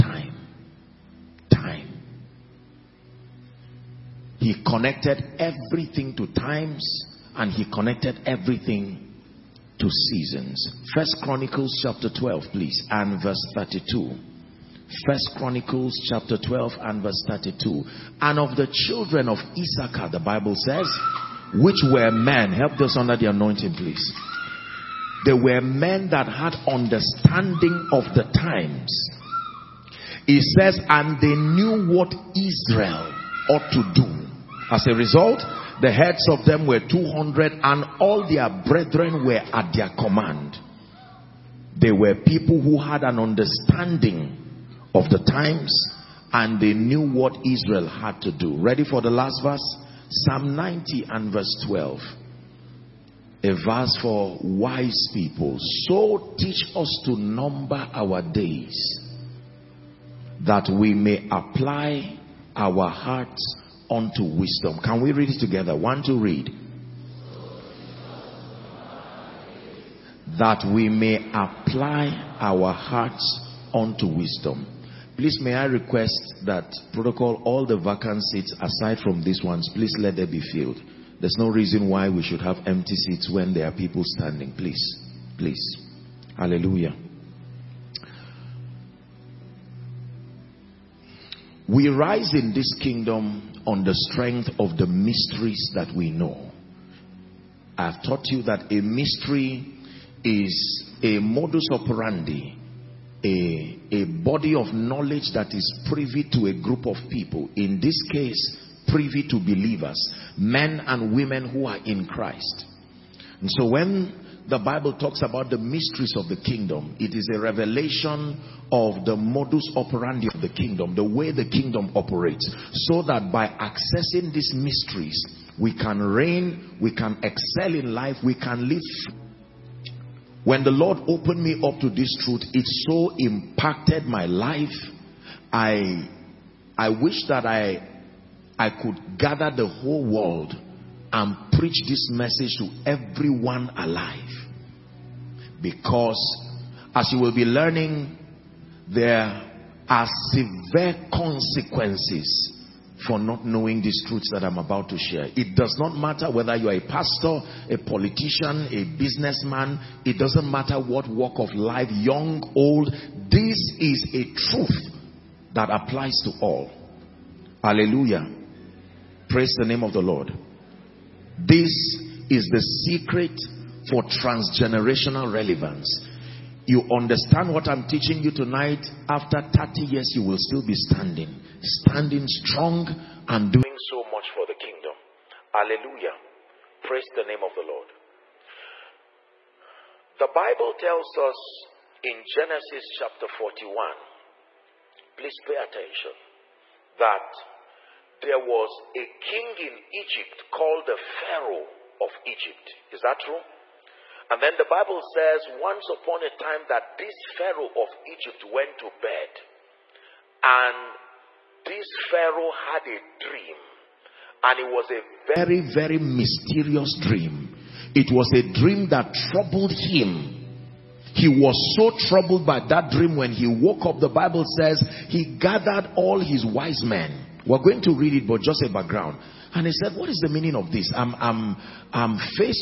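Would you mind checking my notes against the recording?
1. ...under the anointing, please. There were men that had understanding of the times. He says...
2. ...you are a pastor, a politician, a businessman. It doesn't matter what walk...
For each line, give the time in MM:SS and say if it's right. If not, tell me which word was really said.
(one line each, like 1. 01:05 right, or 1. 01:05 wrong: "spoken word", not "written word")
1. 00:22 right
2. 02:36 right.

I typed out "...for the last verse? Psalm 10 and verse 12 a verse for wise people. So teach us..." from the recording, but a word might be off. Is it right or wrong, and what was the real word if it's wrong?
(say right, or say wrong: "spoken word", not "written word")
wrong: "90", not "10".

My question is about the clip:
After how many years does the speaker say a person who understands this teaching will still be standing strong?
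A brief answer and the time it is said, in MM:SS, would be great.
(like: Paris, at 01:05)
30, at 02:59.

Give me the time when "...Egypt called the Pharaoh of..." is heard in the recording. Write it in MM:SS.
03:19.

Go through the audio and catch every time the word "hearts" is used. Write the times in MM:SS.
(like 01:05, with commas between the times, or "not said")
01:02, 01:12.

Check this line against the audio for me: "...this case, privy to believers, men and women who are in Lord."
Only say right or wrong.
wrong.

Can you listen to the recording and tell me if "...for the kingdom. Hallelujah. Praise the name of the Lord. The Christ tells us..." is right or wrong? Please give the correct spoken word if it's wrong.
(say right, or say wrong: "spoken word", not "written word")
wrong: "Bible", not "Christ".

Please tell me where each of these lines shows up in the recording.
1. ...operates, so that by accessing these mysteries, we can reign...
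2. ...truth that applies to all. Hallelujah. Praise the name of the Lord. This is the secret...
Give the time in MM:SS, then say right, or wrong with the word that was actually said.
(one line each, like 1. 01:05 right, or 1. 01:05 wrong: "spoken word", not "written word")
1. 02:01 right
2. 02:44 right.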